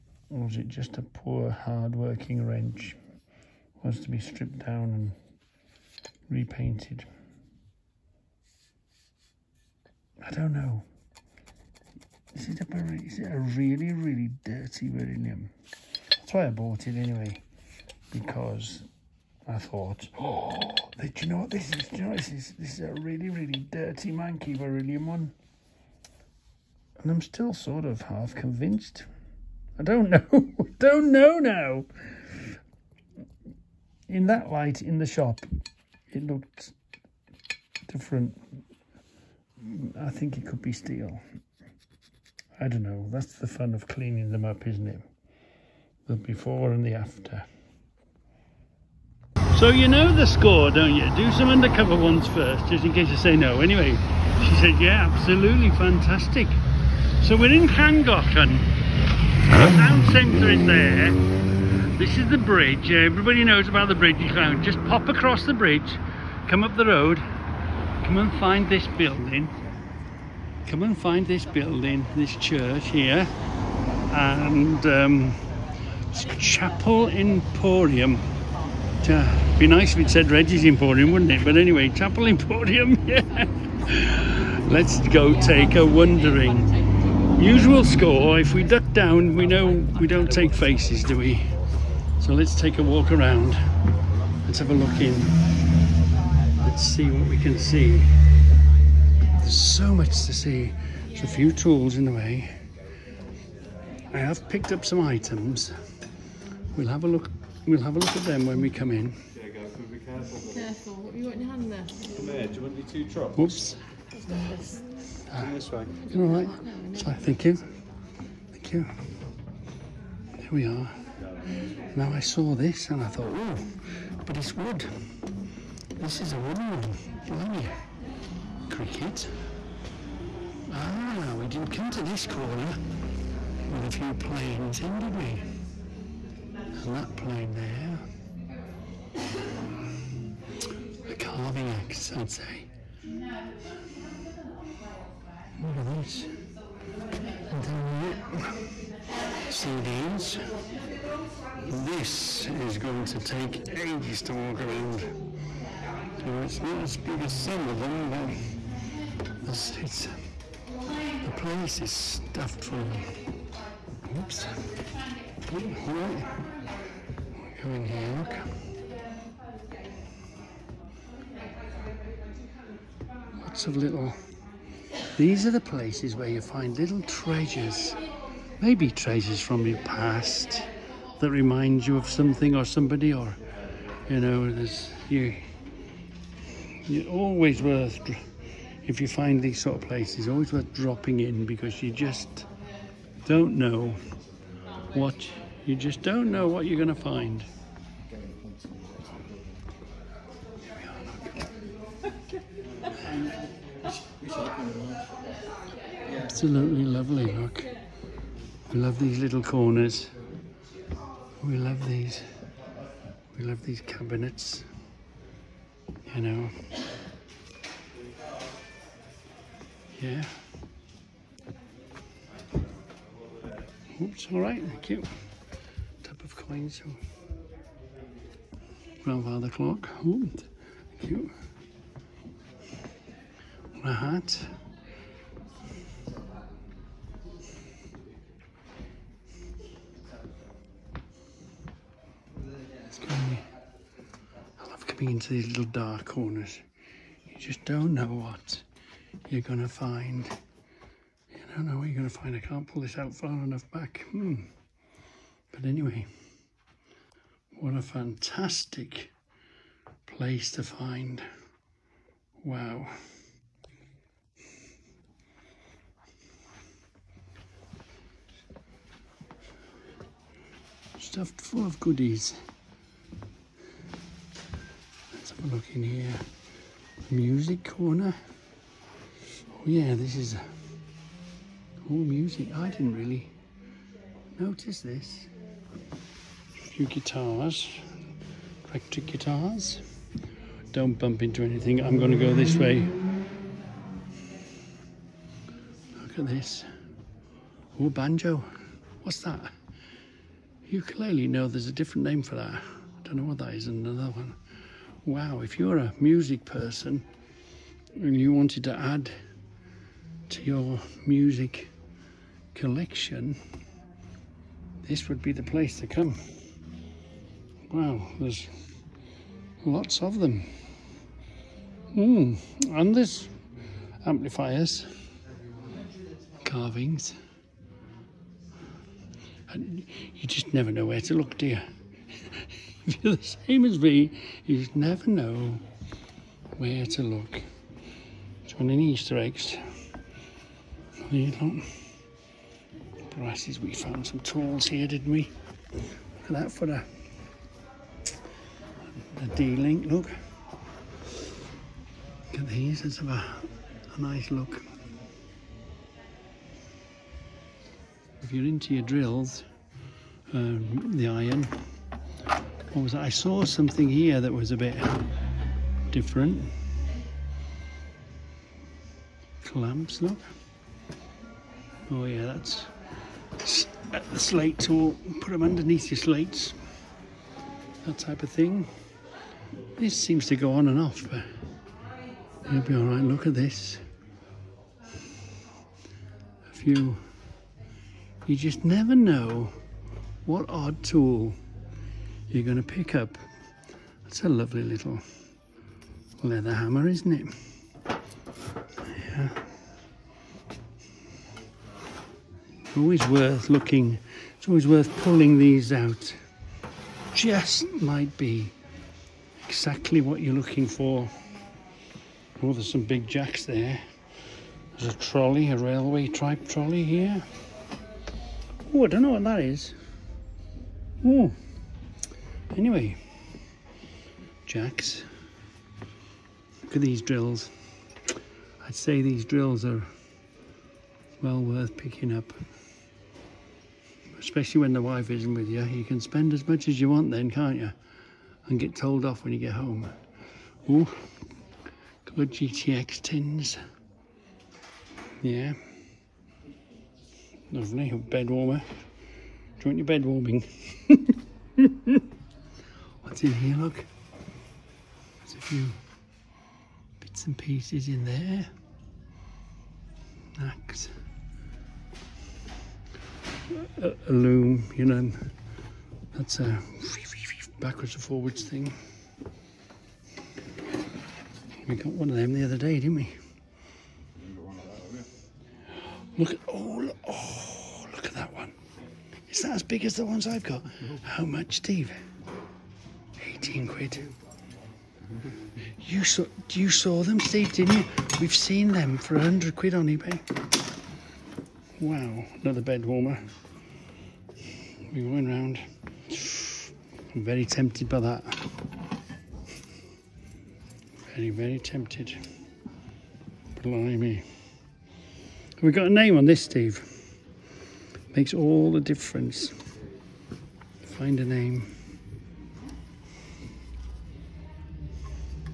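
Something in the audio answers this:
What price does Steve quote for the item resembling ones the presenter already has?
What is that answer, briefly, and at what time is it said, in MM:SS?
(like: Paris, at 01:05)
£18, at 08:03.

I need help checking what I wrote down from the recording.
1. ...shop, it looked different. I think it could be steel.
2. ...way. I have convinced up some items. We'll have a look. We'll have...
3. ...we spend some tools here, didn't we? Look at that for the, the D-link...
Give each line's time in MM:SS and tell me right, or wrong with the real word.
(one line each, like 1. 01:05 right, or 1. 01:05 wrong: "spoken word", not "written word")
1. 00:35 right
2. 01:42 wrong: "picked", not "convinced"
3. 05:43 wrong: "found", not "spend".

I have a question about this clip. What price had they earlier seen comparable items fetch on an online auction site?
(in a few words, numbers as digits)
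£100.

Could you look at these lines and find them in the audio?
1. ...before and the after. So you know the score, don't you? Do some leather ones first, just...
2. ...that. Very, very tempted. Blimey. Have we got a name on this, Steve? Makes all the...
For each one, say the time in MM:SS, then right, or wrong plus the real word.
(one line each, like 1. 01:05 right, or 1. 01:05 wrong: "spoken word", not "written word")
1. 00:46 wrong: "undercover", not "leather"
2. 08:18 right.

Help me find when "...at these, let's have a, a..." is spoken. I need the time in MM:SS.
05:52.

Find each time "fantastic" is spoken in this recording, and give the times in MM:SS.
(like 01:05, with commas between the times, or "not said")
00:55, 04:17.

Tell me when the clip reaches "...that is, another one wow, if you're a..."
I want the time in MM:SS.
05:03.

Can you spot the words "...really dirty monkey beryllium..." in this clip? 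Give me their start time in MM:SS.
00:23.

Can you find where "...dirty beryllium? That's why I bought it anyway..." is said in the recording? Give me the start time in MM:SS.
00:14.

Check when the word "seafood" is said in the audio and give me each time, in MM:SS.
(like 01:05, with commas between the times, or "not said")
not said.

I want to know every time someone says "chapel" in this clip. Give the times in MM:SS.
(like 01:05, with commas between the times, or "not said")
01:16, 01:21.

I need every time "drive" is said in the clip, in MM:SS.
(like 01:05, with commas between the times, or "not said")
not said.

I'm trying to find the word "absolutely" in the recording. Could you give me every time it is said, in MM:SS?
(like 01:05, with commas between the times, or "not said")
00:55, 03:26.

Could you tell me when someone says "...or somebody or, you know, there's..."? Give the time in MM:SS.
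03:02.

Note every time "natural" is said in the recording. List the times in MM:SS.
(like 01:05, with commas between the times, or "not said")
not said.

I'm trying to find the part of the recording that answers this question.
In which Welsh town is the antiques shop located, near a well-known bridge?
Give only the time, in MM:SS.
00:57.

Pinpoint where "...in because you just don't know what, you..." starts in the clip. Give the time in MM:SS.
03:11.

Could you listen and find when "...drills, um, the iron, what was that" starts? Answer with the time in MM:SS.
05:58.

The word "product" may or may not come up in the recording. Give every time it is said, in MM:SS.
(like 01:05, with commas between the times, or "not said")
not said.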